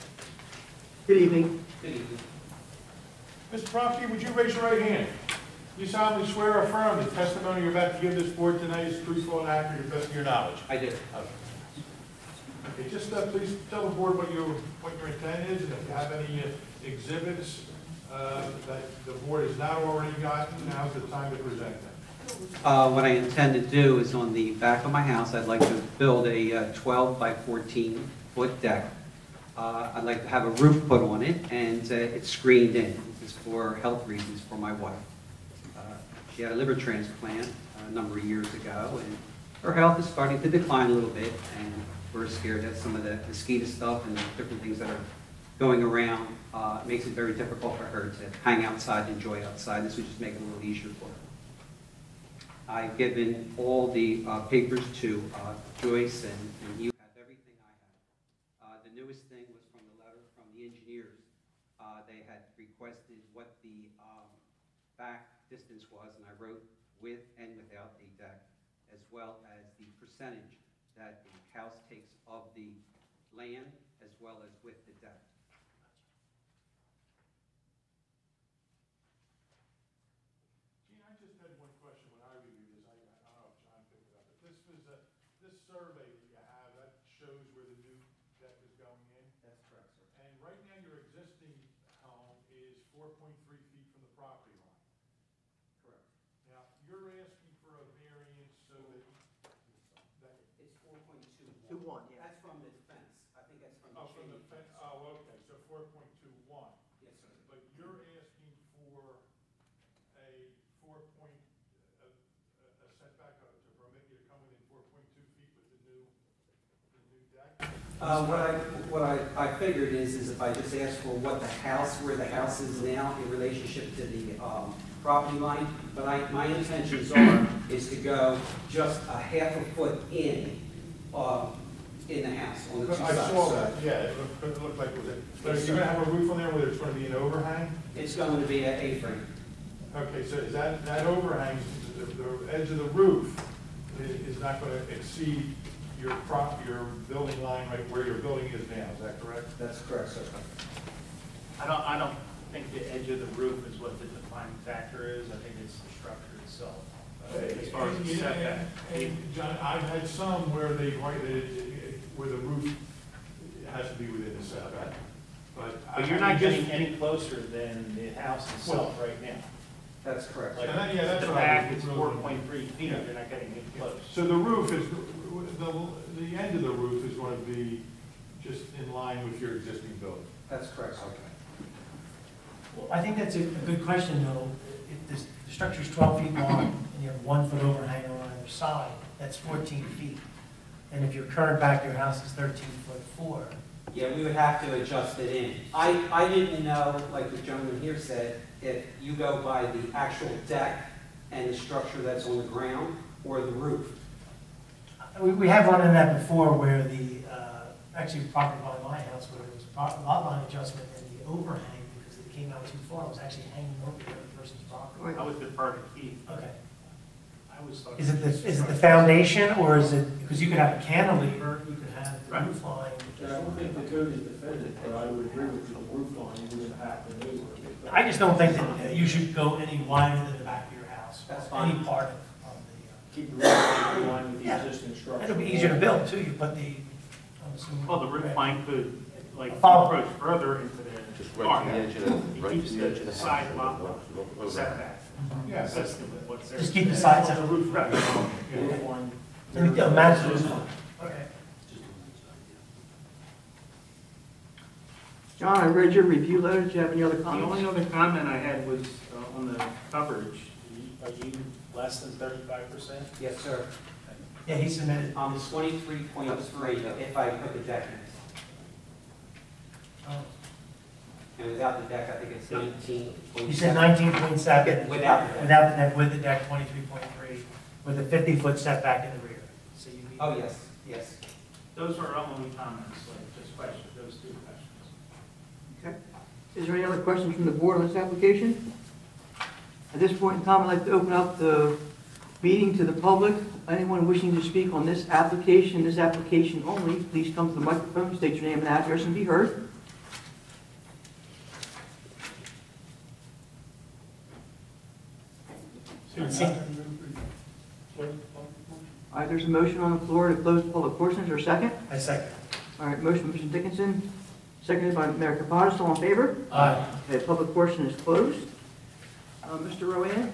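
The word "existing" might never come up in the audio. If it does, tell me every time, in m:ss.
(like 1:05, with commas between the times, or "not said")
1:30, 2:59, 3:54.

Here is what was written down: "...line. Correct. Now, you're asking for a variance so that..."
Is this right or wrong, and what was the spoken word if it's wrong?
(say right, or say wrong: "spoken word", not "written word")
right.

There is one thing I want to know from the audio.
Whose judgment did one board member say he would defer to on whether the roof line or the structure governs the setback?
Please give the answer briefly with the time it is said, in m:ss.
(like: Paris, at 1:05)
Keith, at 3:35.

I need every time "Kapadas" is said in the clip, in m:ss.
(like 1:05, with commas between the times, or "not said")
5:15.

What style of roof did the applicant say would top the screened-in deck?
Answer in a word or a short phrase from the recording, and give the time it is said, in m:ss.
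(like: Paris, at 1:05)
A-frame, at 2:18.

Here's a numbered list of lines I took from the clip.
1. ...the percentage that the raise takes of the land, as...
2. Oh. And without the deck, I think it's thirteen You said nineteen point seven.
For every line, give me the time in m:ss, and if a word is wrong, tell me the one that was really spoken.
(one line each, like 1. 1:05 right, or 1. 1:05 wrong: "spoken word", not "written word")
1. 1:09 wrong: "house", not "raise"
2. 4:30 wrong: "nineteen", not "thirteen".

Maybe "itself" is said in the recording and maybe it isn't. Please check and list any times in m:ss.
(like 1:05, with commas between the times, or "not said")
2:36, 2:48.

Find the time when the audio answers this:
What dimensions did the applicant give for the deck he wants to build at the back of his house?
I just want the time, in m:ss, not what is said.
0:26.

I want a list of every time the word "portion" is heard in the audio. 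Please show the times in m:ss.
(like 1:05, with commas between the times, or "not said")
5:10, 5:17.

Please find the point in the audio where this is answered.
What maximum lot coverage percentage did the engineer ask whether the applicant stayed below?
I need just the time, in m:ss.
4:22.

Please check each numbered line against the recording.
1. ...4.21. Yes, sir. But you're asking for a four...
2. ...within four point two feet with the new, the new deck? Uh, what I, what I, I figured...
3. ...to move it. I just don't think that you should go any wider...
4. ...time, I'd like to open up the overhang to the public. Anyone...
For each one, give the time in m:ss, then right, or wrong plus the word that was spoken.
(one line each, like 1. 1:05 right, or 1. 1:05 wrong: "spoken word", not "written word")
1. 1:45 right
2. 1:54 right
3. 3:47 right
4. 4:50 wrong: "meeting", not "overhang".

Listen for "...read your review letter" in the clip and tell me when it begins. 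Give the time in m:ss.
4:15.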